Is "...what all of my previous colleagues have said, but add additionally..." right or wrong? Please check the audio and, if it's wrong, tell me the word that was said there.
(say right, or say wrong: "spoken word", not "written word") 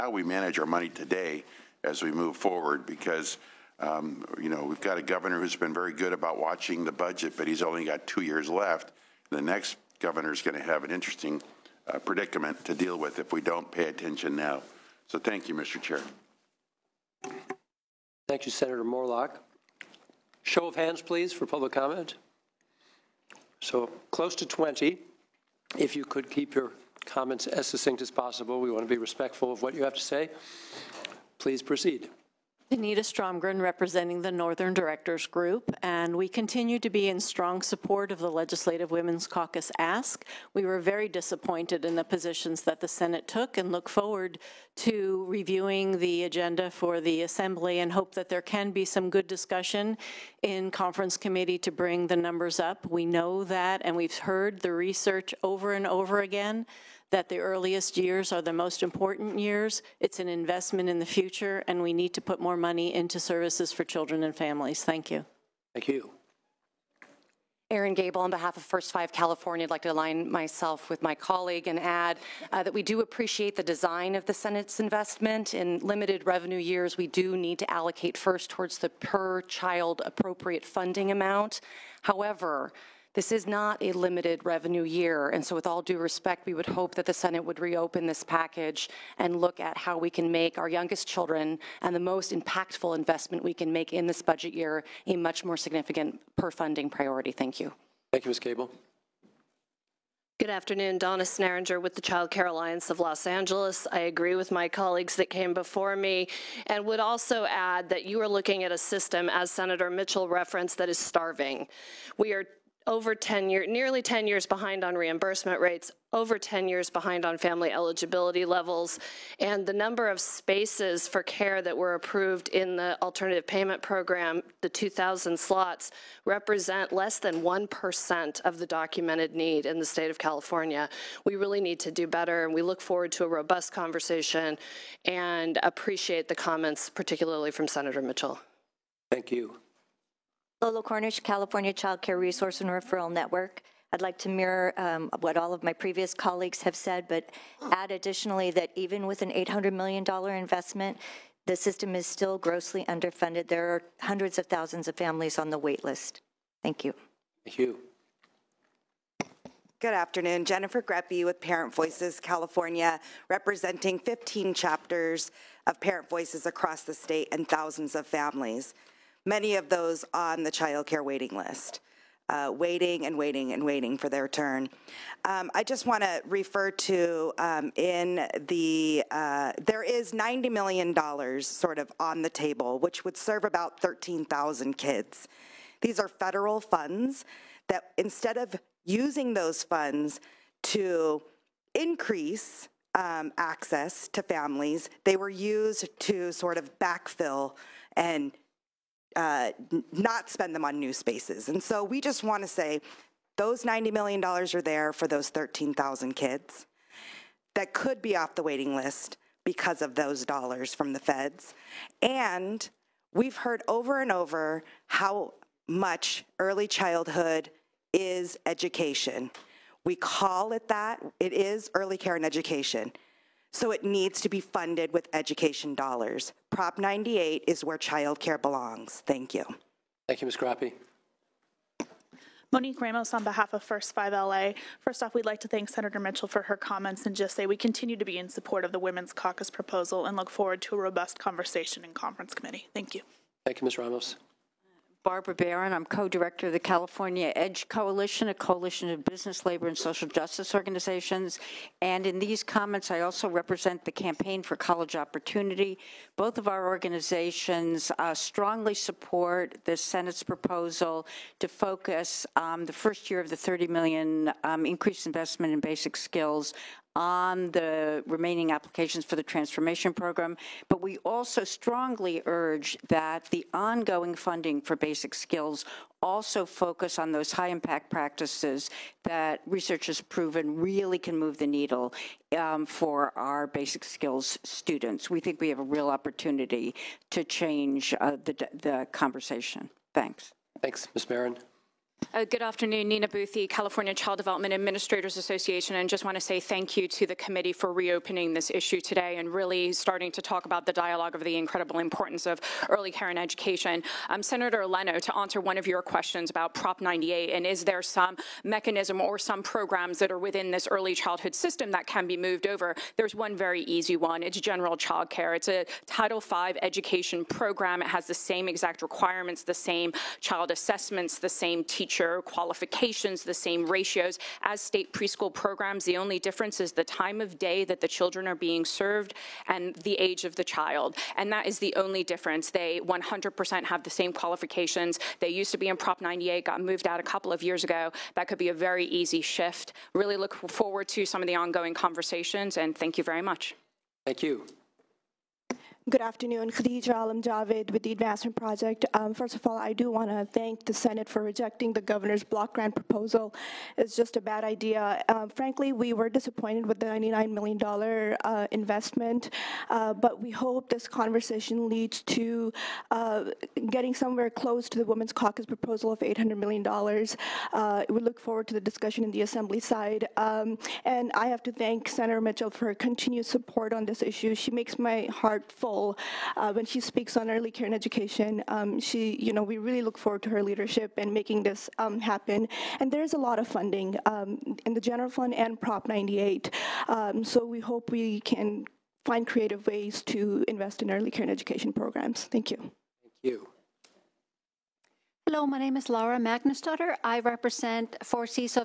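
right.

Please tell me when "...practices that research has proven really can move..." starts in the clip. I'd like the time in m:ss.
4:37.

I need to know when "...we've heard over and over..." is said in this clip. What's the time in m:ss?
3:33.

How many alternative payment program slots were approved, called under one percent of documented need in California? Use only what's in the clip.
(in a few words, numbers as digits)
2,000.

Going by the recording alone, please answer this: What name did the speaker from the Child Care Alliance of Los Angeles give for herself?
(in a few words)
Donna Sneeringer.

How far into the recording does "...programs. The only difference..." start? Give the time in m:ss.
5:25.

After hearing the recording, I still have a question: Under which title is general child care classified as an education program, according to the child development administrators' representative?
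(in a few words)
Title V.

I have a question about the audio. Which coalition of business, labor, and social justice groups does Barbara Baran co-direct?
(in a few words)
California EDGE Coalition.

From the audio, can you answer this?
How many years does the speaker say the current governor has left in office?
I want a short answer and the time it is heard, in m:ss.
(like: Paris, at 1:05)
2, at 0:08.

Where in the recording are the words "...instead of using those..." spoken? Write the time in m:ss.
3:07.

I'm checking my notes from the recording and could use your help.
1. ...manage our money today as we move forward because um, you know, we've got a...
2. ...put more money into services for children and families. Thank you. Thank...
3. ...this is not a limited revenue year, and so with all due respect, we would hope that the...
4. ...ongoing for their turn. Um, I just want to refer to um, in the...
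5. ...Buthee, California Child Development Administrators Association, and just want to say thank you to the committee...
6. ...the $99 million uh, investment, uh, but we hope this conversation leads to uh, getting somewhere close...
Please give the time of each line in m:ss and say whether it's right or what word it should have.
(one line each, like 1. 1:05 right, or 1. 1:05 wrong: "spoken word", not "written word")
1. 0:00 right
2. 1:02 right
3. 1:23 right
4. 2:53 wrong: "waiting", not "ongoing"
5. 4:53 right
6. 5:56 right.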